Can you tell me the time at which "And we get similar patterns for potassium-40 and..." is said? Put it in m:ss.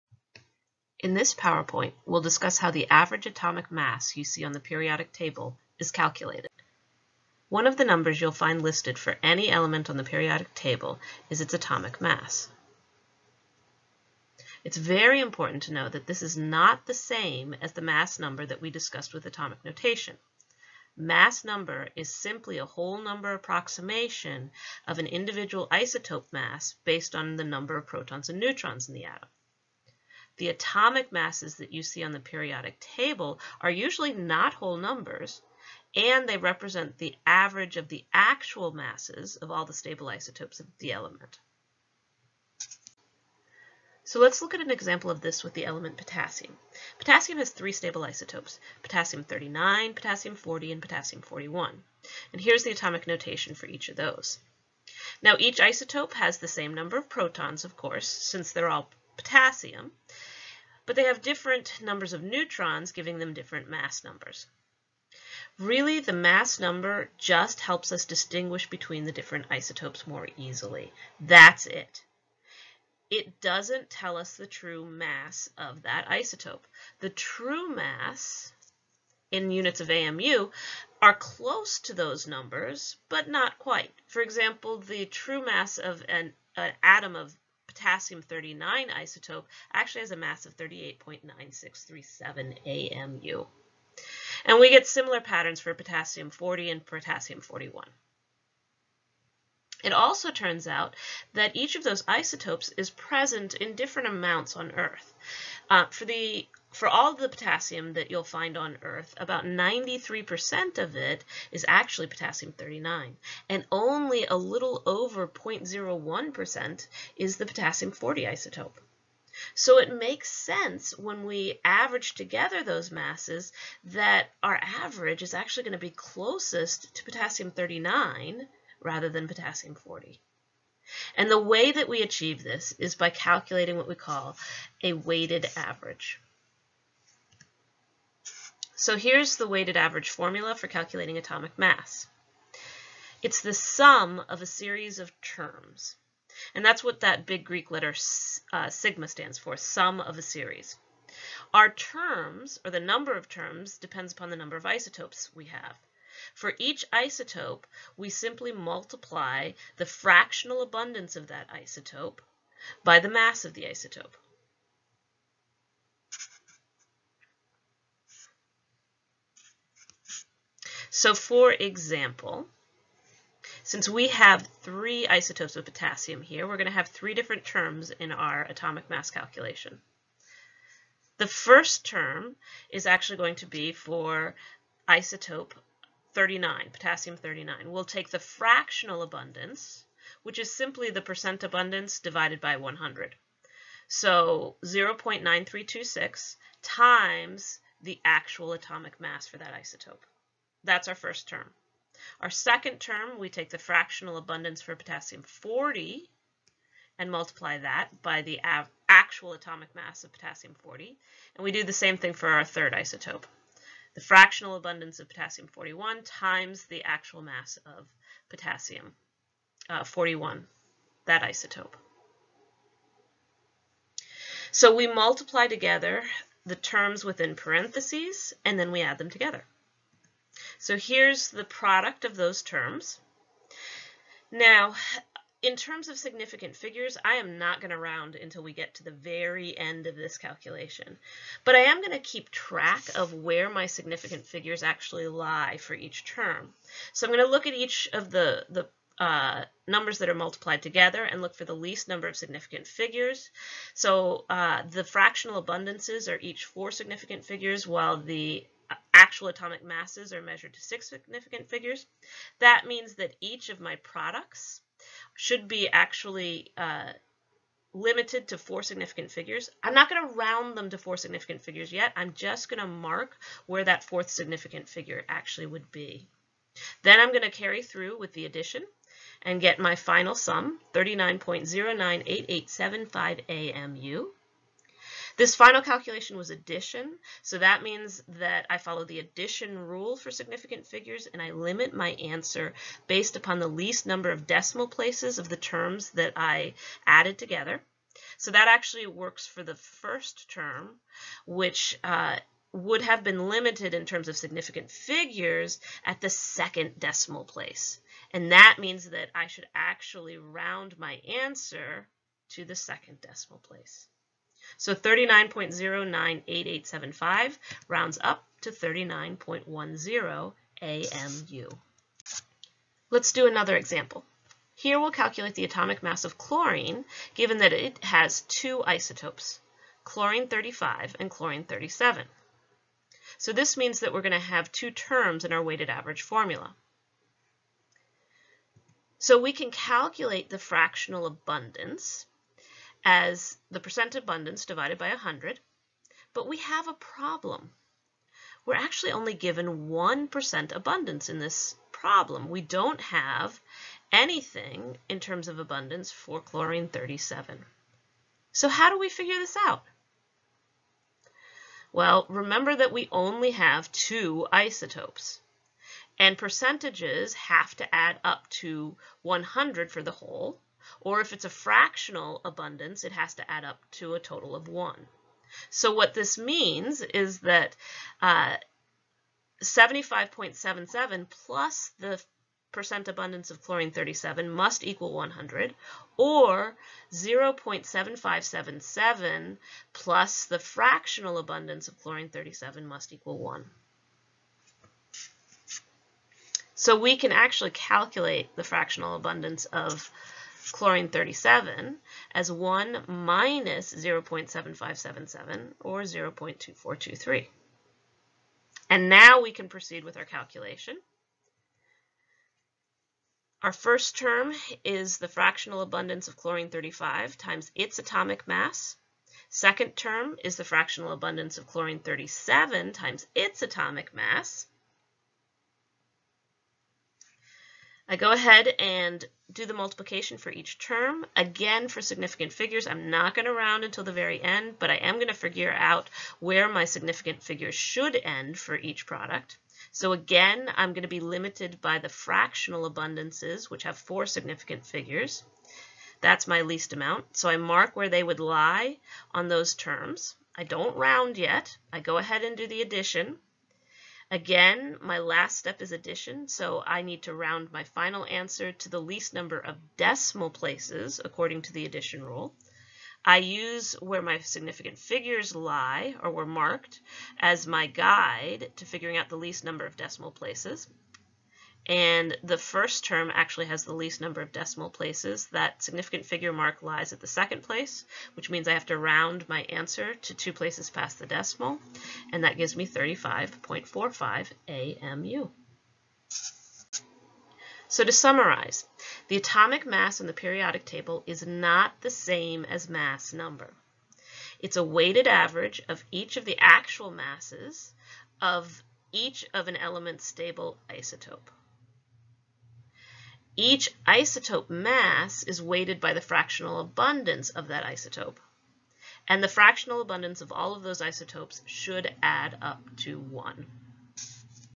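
1:34.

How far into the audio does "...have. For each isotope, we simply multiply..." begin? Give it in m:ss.
2:35.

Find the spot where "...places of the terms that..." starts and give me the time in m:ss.
4:54.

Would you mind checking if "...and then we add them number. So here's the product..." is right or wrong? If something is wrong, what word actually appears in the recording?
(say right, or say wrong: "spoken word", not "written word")
wrong: "together", not "number".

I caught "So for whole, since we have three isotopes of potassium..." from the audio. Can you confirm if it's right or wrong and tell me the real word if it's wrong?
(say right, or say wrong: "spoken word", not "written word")
wrong: "example", not "whole".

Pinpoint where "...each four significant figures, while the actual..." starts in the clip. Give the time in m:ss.
4:16.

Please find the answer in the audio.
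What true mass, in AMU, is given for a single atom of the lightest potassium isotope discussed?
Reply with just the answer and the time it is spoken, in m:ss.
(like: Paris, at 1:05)
38.9637 AMU, at 1:30.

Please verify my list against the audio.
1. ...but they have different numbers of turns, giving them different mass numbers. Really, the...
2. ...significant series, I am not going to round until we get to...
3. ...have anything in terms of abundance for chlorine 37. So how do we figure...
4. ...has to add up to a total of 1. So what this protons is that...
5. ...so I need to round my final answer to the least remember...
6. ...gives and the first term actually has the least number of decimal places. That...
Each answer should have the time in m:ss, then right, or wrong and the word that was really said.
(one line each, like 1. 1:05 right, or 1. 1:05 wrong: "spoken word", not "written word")
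1. 1:00 wrong: "neutrons", not "turns"
2. 3:55 wrong: "figures", not "series"
3. 5:52 right
4. 6:12 wrong: "means", not "protons"
5. 7:36 wrong: "number", not "remember"
6. 7:50 wrong: "places", not "gives".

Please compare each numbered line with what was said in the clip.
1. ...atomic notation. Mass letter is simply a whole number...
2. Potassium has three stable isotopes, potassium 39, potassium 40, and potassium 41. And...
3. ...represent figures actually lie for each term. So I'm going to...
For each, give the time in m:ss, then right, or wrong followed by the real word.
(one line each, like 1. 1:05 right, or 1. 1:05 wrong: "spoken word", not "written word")
1. 0:19 wrong: "number", not "letter"
2. 0:46 right
3. 4:03 wrong: "significant", not "represent".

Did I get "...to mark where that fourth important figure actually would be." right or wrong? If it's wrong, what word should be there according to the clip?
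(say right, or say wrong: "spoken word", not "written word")
wrong: "significant", not "important".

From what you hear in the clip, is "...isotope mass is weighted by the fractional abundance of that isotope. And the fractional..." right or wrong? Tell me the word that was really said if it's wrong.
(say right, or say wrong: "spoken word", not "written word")
right.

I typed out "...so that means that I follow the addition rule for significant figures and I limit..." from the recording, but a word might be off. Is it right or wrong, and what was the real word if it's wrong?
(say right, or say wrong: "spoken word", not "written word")
right.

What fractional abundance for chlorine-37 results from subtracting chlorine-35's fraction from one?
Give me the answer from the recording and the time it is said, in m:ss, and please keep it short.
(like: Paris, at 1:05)
0.2423, at 6:45.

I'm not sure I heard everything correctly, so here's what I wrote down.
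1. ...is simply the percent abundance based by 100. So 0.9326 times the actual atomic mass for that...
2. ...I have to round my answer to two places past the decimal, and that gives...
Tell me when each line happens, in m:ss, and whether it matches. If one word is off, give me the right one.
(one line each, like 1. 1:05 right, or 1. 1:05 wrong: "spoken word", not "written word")
1. 3:10 wrong: "divided", not "based"
2. 7:58 right.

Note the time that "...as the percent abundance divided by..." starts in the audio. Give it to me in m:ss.
5:42.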